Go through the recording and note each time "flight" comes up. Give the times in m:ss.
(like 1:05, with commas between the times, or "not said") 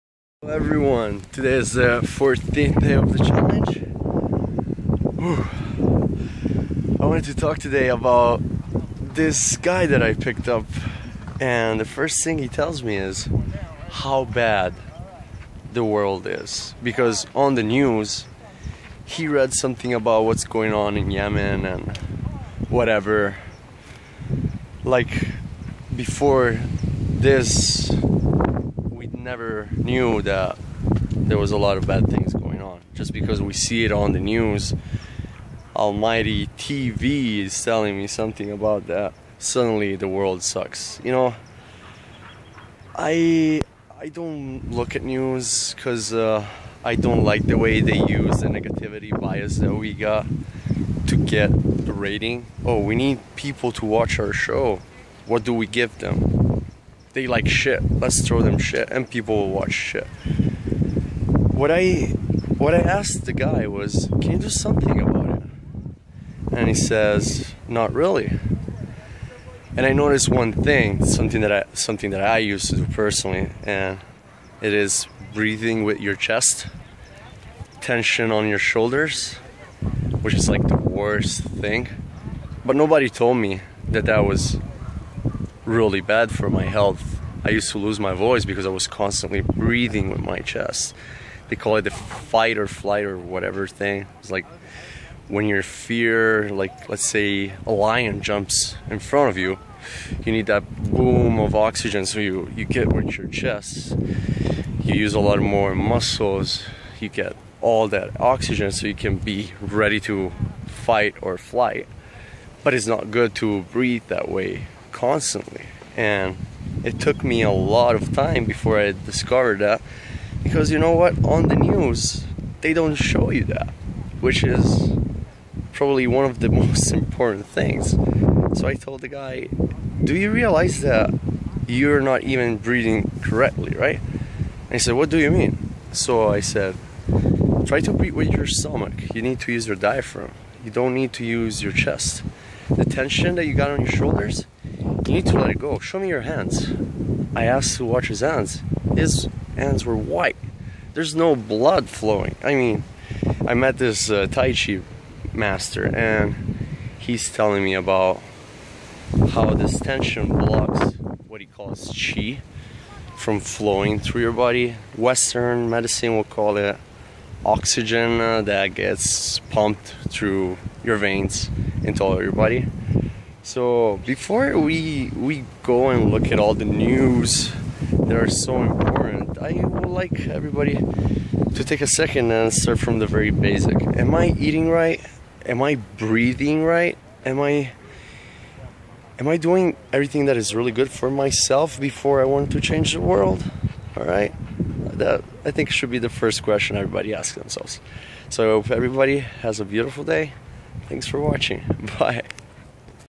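1:32, 1:51.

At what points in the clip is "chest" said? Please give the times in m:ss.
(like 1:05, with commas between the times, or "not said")
1:16, 1:30, 1:43, 2:21.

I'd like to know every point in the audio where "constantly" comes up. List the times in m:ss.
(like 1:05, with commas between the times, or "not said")
1:28, 1:54.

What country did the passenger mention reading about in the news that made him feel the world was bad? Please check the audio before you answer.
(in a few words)
Yemen.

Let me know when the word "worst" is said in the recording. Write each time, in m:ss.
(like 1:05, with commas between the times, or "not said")
1:20.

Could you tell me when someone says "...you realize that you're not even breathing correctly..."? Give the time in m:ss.
2:10.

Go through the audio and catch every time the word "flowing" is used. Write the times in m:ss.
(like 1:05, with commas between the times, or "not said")
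2:31, 2:43.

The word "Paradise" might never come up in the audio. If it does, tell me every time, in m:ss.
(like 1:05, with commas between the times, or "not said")
not said.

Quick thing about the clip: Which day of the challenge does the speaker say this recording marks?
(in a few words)
14th.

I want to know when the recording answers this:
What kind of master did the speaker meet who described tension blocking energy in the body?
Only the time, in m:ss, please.
2:34.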